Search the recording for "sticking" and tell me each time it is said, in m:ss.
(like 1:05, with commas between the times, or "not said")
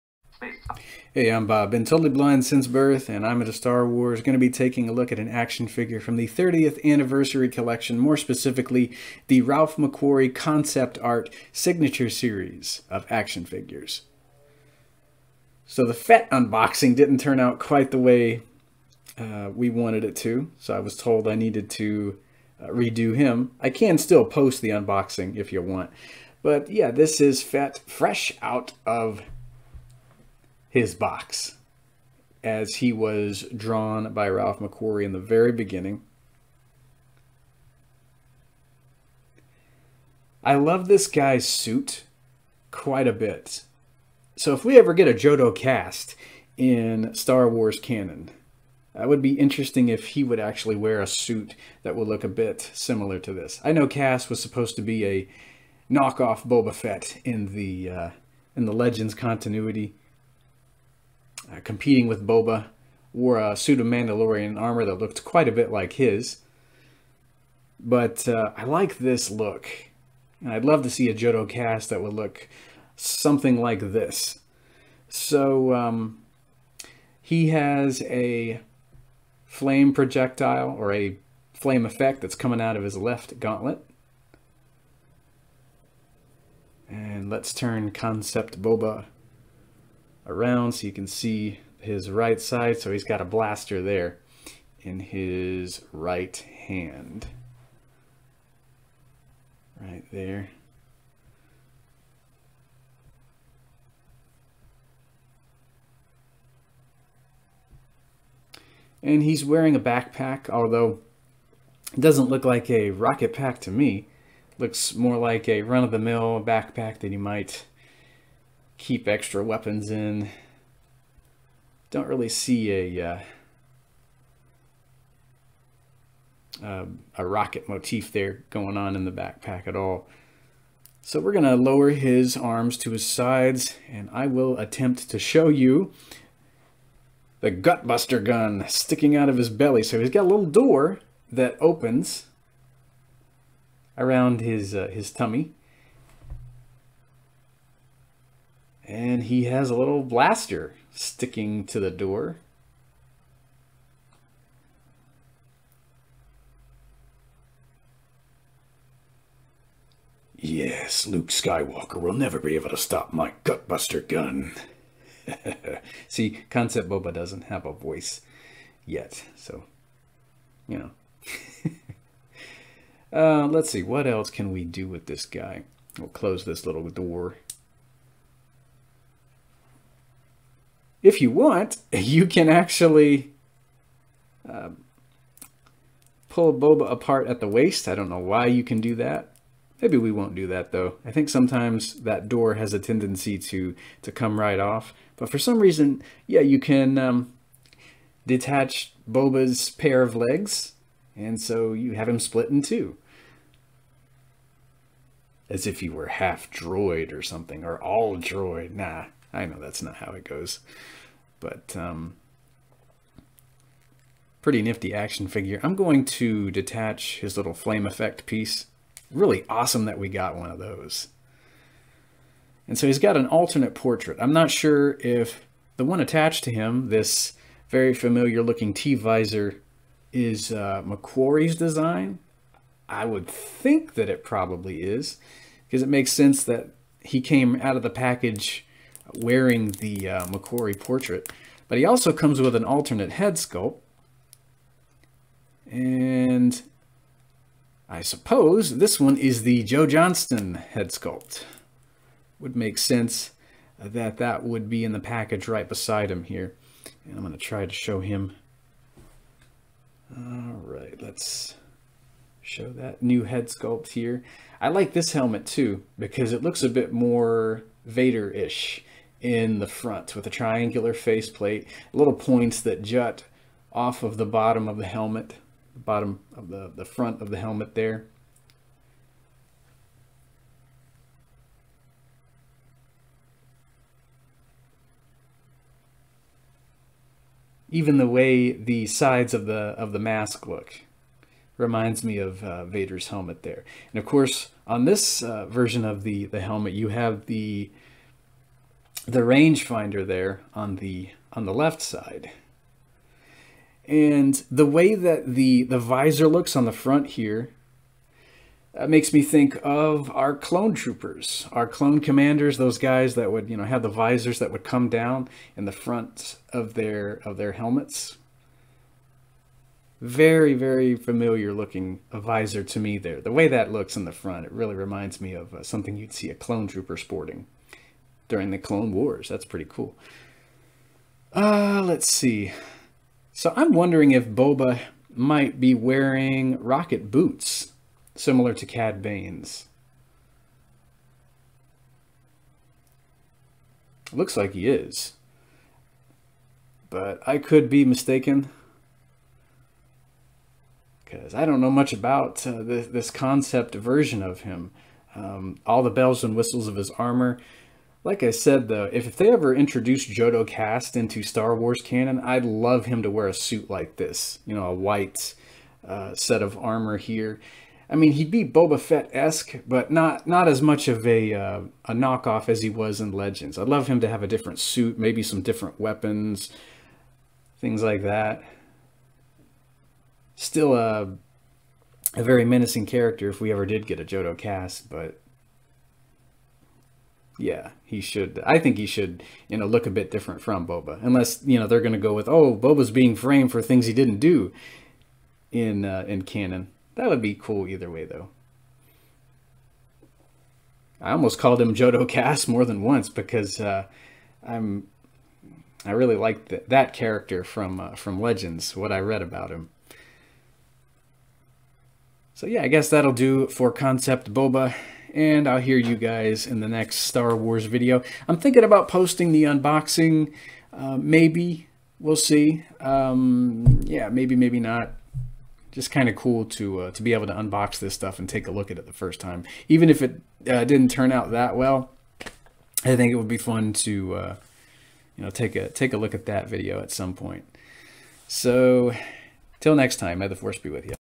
2:18, 2:30.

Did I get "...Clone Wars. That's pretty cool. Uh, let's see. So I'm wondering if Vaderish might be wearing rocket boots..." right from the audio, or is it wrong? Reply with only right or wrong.
wrong.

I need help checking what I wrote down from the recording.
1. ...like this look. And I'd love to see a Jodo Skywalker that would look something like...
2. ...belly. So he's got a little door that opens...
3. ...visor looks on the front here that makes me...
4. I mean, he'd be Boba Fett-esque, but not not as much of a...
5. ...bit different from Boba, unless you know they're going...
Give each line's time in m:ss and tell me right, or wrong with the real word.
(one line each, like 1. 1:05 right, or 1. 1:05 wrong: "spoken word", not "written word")
1. 1:08 wrong: "Kast", not "Skywalker"
2. 2:19 right
3. 5:05 right
4. 6:07 right
5. 6:29 right.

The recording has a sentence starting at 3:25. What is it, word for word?
As if he were half droid or something, or all droid.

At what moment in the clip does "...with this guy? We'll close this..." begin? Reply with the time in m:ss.
2:54.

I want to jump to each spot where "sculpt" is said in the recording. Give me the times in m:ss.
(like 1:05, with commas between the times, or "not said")
4:03, 4:10, 4:23.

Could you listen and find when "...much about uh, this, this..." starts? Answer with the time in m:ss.
5:51.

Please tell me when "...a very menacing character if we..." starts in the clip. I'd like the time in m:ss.
6:22.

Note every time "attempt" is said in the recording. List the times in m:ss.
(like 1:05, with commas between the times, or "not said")
2:14.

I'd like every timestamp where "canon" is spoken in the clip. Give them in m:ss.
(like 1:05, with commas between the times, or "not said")
0:47, 6:01, 6:36.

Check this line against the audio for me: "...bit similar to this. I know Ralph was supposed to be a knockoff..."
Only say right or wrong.
wrong.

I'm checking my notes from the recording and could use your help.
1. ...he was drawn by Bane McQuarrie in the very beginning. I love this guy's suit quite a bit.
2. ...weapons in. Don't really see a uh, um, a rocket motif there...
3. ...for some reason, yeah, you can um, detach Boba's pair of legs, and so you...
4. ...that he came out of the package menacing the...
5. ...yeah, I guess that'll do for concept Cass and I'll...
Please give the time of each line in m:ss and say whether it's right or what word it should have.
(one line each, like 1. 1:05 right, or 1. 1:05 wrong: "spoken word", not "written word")
1. 0:32 wrong: "Ralph", not "Bane"
2. 1:59 right
3. 3:15 right
4. 3:56 wrong: "wearing", not "menacing"
5. 6:52 wrong: "Boba", not "Cass".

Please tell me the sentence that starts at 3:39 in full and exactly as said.
Really awesome that we got one of those.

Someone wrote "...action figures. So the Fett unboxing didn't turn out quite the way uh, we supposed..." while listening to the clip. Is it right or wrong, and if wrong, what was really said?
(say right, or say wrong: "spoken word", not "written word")
wrong: "wanted", not "supposed".